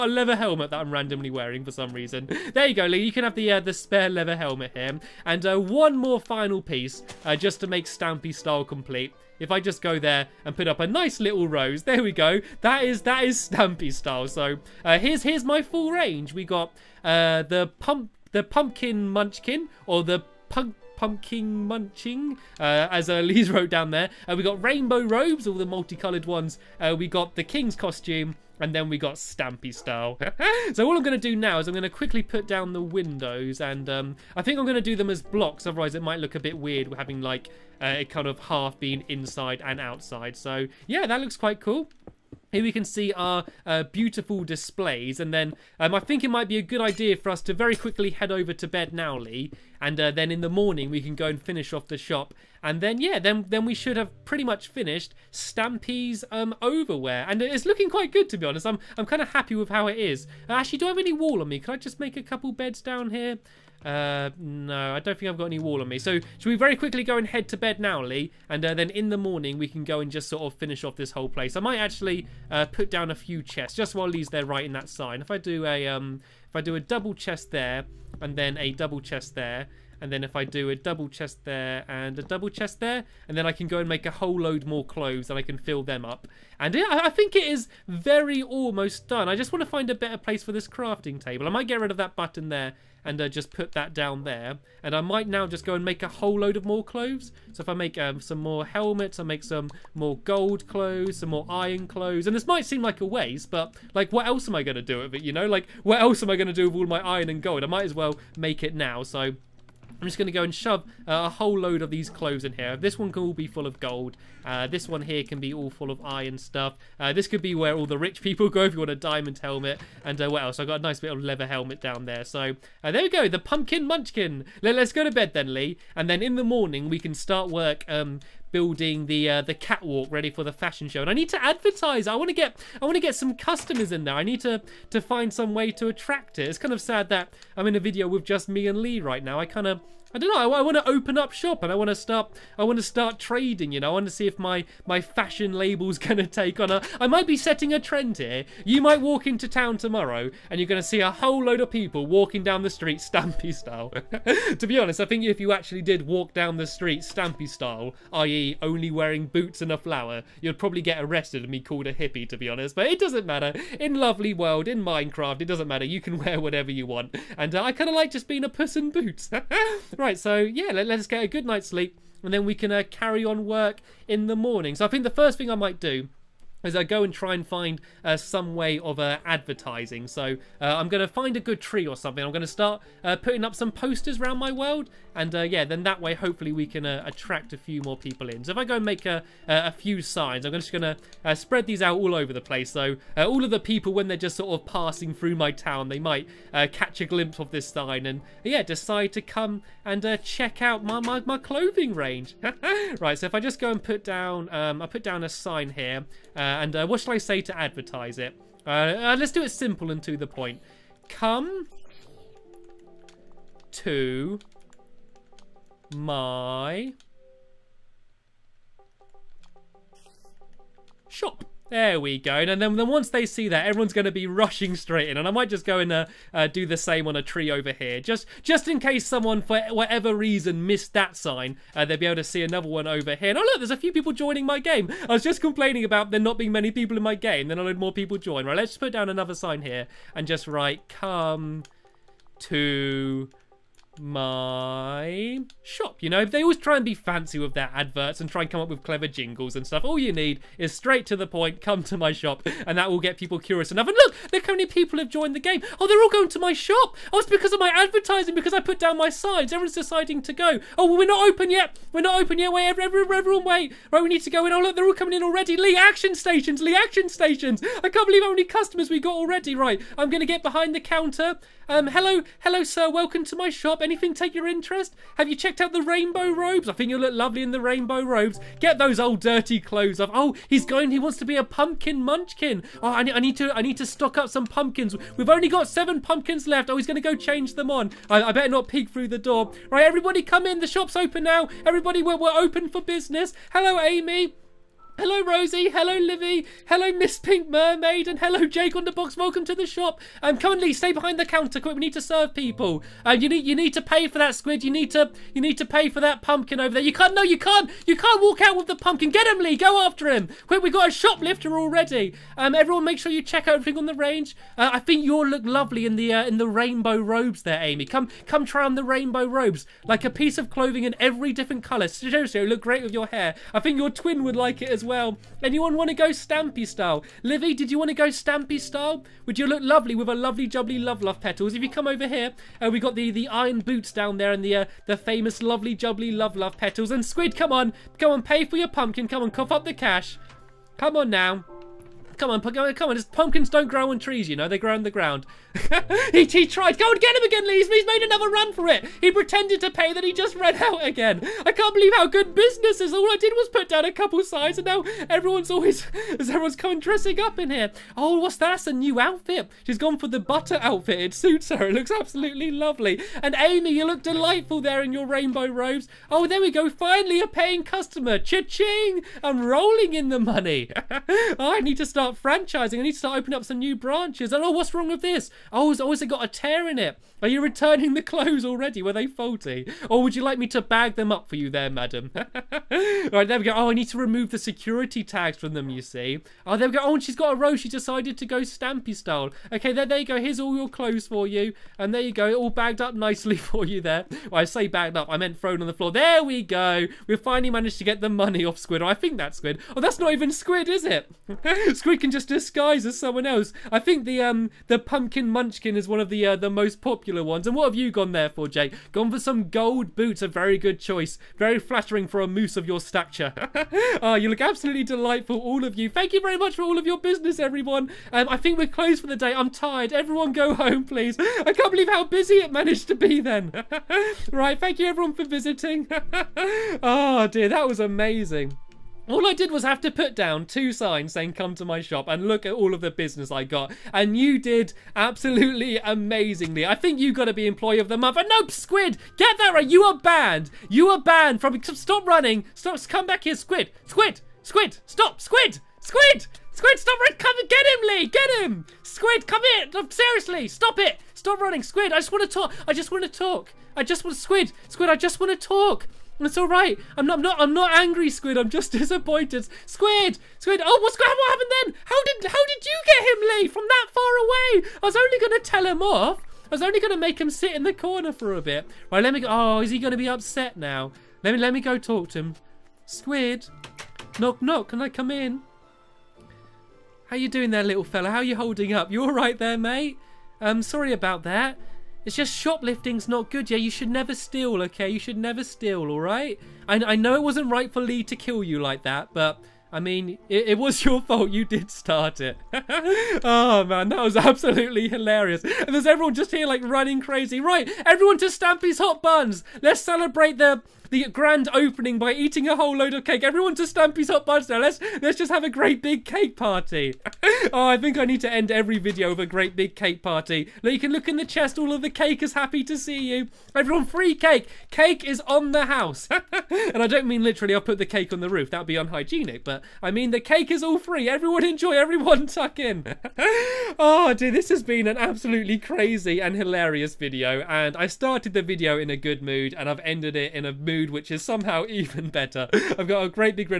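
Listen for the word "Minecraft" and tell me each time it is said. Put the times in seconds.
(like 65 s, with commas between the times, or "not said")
164 s.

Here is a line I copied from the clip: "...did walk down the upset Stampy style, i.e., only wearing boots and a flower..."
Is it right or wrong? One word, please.
wrong.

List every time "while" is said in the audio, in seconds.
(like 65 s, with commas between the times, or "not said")
73 s.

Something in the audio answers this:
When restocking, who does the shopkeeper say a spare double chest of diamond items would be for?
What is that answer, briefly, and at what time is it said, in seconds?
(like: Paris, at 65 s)
Rich people, at 117 s.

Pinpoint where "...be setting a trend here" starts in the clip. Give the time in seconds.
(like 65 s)
147 s.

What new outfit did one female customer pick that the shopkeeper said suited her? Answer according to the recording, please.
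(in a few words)
Butter outfit.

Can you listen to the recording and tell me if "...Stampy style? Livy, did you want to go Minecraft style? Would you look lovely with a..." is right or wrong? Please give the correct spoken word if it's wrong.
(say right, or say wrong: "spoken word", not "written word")
wrong: "Stampy", not "Minecraft".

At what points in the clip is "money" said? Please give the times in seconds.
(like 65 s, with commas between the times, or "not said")
370 s, 398 s.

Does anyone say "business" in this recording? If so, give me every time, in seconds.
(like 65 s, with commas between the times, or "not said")
292 s, 352 s, 416 s, 432 s.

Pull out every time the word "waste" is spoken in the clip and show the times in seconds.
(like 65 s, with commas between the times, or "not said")
103 s.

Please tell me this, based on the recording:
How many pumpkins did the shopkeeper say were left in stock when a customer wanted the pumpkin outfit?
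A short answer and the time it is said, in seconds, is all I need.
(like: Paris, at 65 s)
7, at 285 s.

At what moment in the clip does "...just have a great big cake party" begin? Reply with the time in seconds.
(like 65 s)
505 s.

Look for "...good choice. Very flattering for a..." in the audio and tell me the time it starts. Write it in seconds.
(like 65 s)
410 s.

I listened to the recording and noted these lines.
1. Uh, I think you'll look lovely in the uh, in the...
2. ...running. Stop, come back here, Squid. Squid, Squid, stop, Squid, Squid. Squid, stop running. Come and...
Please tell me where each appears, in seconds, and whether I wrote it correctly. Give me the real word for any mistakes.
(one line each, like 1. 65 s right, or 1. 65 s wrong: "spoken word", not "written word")
1. 314 s right
2. 442 s right.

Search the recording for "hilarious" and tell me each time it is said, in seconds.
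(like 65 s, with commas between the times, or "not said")
494 s, 526 s.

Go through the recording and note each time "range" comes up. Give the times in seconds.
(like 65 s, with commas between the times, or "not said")
15 s, 201 s, 313 s.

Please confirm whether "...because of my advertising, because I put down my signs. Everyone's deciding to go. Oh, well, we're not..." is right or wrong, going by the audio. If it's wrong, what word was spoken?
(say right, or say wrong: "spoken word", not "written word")
right.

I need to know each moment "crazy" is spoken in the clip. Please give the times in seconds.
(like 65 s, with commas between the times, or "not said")
497 s, 525 s.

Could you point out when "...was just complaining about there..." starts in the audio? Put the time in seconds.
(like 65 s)
235 s.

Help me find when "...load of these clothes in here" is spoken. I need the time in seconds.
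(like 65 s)
111 s.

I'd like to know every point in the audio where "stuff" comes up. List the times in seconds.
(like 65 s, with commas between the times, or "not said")
116 s, 249 s.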